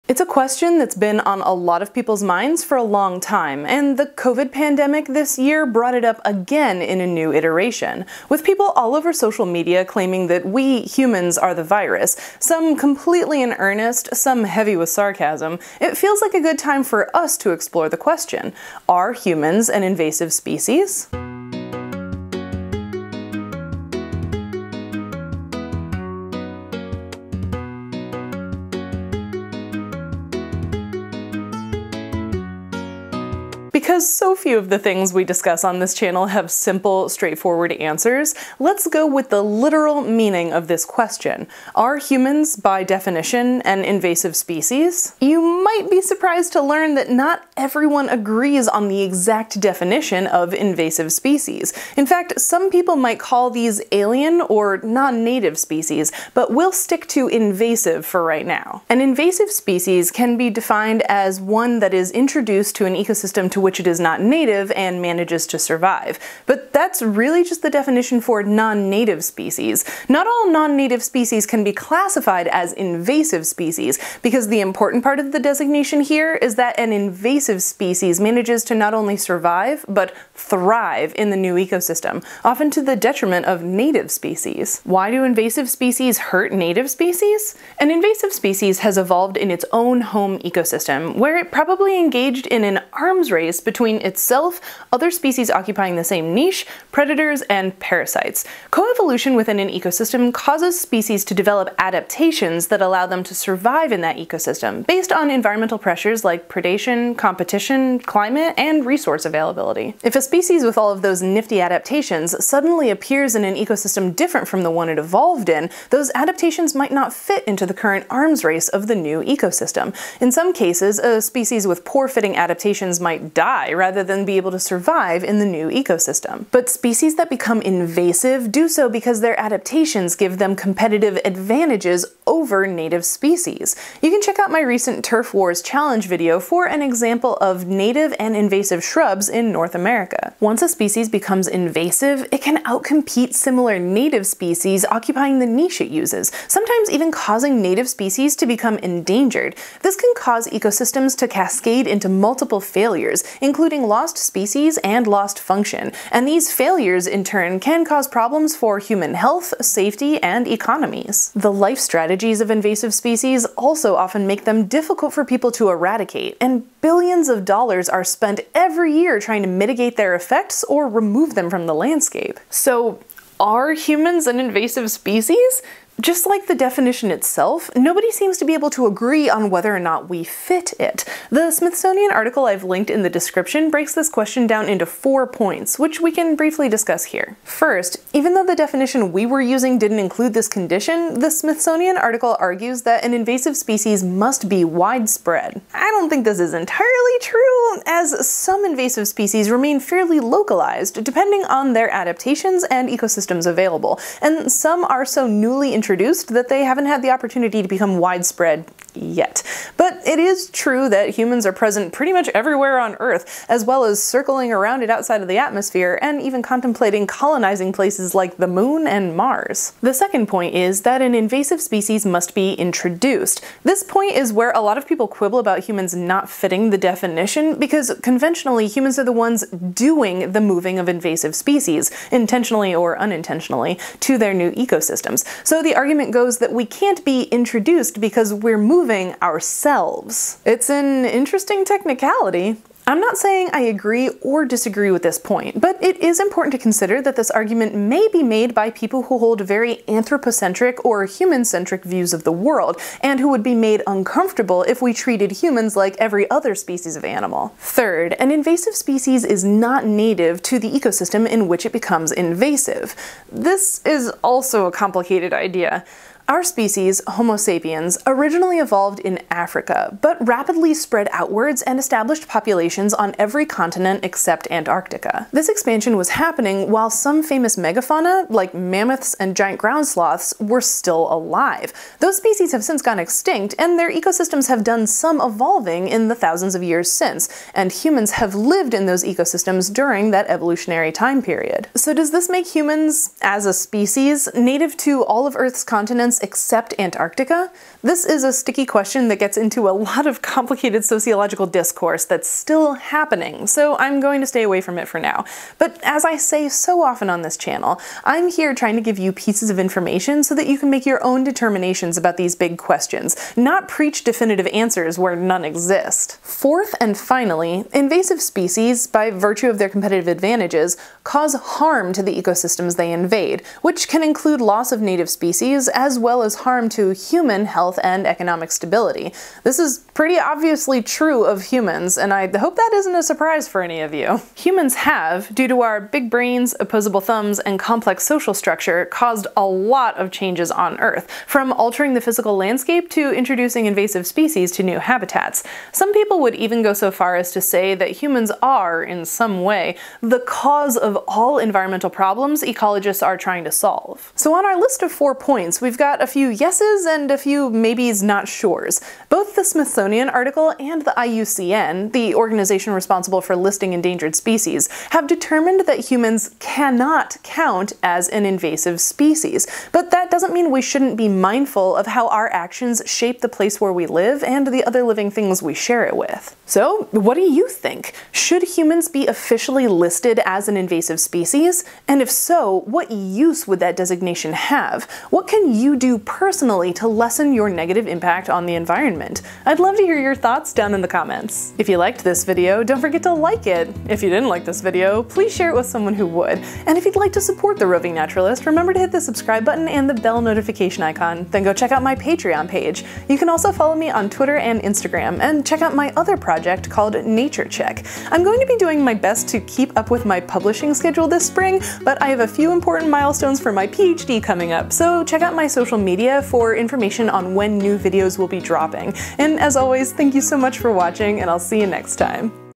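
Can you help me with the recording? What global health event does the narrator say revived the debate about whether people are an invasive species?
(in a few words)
COVID pandemic.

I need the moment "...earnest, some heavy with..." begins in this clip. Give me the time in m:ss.
0:13.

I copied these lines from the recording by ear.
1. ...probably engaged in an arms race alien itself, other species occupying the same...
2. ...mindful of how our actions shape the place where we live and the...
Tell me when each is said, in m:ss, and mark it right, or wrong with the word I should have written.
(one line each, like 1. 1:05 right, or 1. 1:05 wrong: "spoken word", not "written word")
1. 1:31 wrong: "between", not "alien"
2. 6:11 right.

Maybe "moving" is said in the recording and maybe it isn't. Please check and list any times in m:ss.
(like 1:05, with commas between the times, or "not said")
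3:50, 3:58.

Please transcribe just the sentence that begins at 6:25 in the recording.
What can you do personally to lessen your negative impact on the environment?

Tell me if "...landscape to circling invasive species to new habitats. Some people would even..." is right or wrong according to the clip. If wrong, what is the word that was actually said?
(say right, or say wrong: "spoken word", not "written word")
wrong: "introducing", not "circling".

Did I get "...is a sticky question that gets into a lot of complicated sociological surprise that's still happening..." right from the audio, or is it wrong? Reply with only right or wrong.
wrong.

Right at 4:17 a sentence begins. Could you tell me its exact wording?
Third, an invasive species is not native to the ecosystem in which it becomes invasive.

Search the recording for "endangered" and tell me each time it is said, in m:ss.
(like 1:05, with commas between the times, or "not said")
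2:28, 6:03.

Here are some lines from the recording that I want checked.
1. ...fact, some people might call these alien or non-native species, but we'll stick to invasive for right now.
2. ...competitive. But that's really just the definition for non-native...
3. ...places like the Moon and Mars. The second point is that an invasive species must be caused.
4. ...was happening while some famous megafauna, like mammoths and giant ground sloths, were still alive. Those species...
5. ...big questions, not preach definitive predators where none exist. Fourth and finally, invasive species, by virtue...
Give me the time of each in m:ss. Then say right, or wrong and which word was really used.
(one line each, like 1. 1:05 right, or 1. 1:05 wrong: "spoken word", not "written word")
1. 0:52 right
2. 1:05 wrong: "survive", not "competitive"
3. 3:37 wrong: "introduced", not "caused"
4. 4:35 right
5. 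5:12 wrong: "answers", not "predators".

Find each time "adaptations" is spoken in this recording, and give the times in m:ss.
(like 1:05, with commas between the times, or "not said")
1:41, 1:51, 1:56, 2:02, 2:09, 3:21.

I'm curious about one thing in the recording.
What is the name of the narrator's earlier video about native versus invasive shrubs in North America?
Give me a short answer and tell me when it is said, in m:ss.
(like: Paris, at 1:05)
Turf Wars Challenge, at 2:15.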